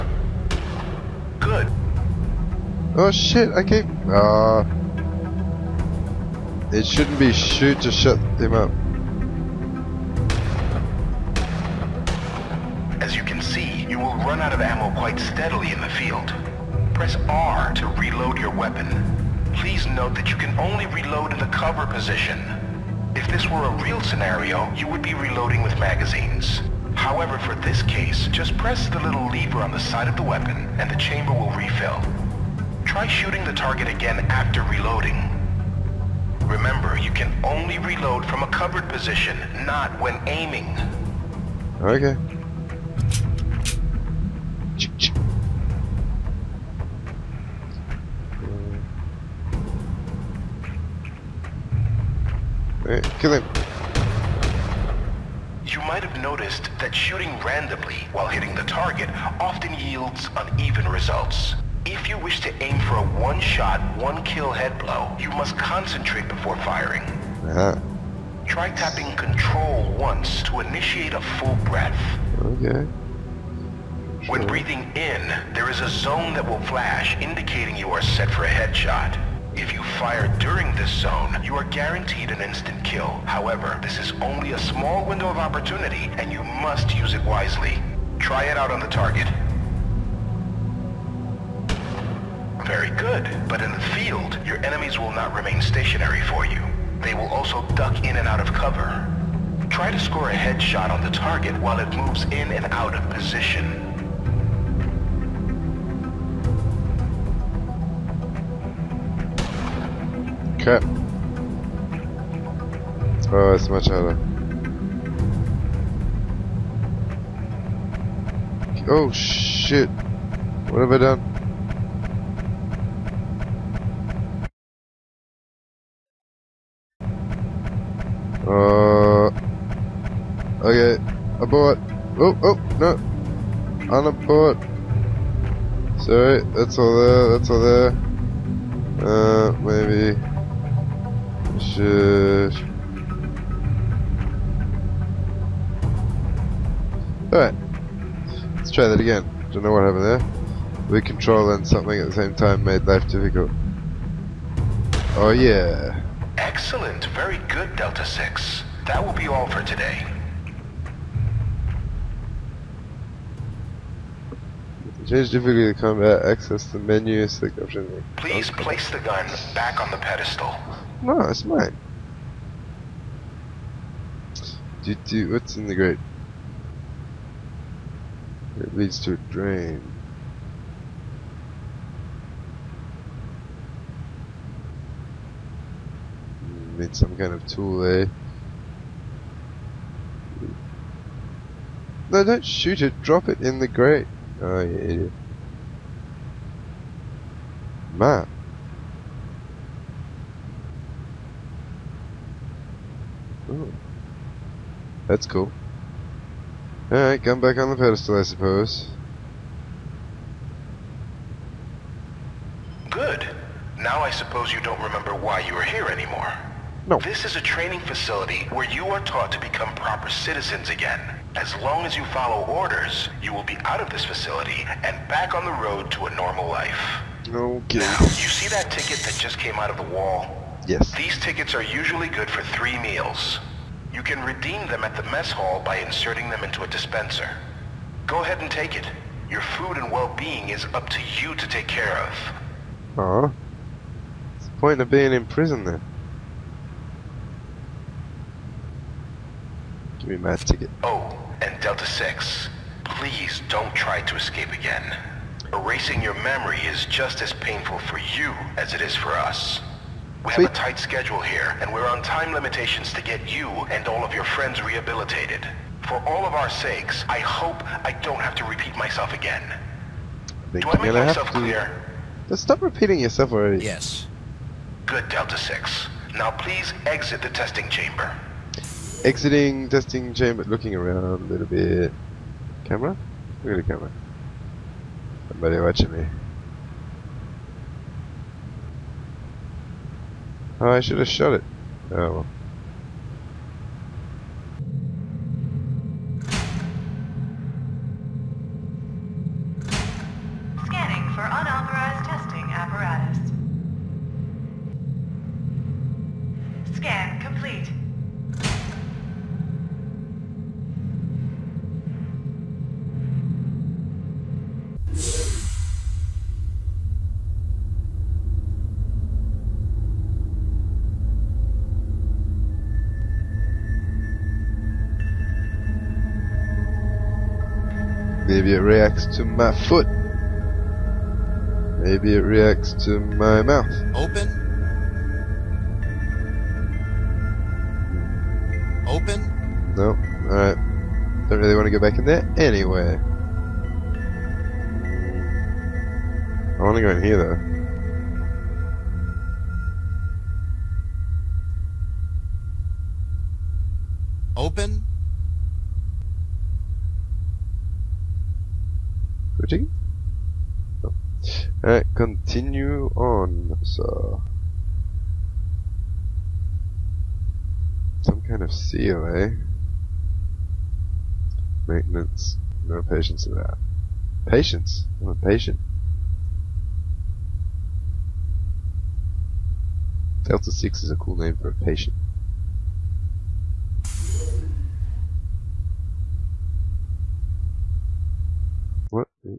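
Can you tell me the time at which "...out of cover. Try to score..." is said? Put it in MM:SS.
01:38.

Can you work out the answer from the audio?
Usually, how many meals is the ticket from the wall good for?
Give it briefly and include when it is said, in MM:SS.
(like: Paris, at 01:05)
3, at 03:52.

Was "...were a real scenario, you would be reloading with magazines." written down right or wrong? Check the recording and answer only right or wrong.
right.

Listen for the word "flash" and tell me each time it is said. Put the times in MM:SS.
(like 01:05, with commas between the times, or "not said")
01:16.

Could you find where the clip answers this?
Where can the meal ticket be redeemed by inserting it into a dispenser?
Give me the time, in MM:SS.
03:55.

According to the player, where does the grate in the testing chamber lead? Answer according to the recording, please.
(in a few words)
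A drain.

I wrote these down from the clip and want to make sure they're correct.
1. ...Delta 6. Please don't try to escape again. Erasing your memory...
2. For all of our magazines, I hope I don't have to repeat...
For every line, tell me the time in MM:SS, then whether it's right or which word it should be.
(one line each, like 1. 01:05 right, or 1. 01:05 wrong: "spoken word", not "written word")
1. 04:11 right
2. 04:25 wrong: "sakes", not "magazines".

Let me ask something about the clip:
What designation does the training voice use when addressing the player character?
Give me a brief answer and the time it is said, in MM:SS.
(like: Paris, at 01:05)
Delta 6, at 02:37.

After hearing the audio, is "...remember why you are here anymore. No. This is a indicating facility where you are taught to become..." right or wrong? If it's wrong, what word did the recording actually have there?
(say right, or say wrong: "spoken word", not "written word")
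wrong: "training", not "indicating".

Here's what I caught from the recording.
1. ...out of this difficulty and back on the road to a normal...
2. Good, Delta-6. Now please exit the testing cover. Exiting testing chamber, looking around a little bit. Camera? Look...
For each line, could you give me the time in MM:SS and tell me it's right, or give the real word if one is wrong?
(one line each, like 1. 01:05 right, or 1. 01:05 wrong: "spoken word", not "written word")
1. 03:43 wrong: "facility", not "difficulty"
2. 04:34 wrong: "chamber", not "cover".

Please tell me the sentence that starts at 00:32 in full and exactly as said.
Try shooting the target again after reloading.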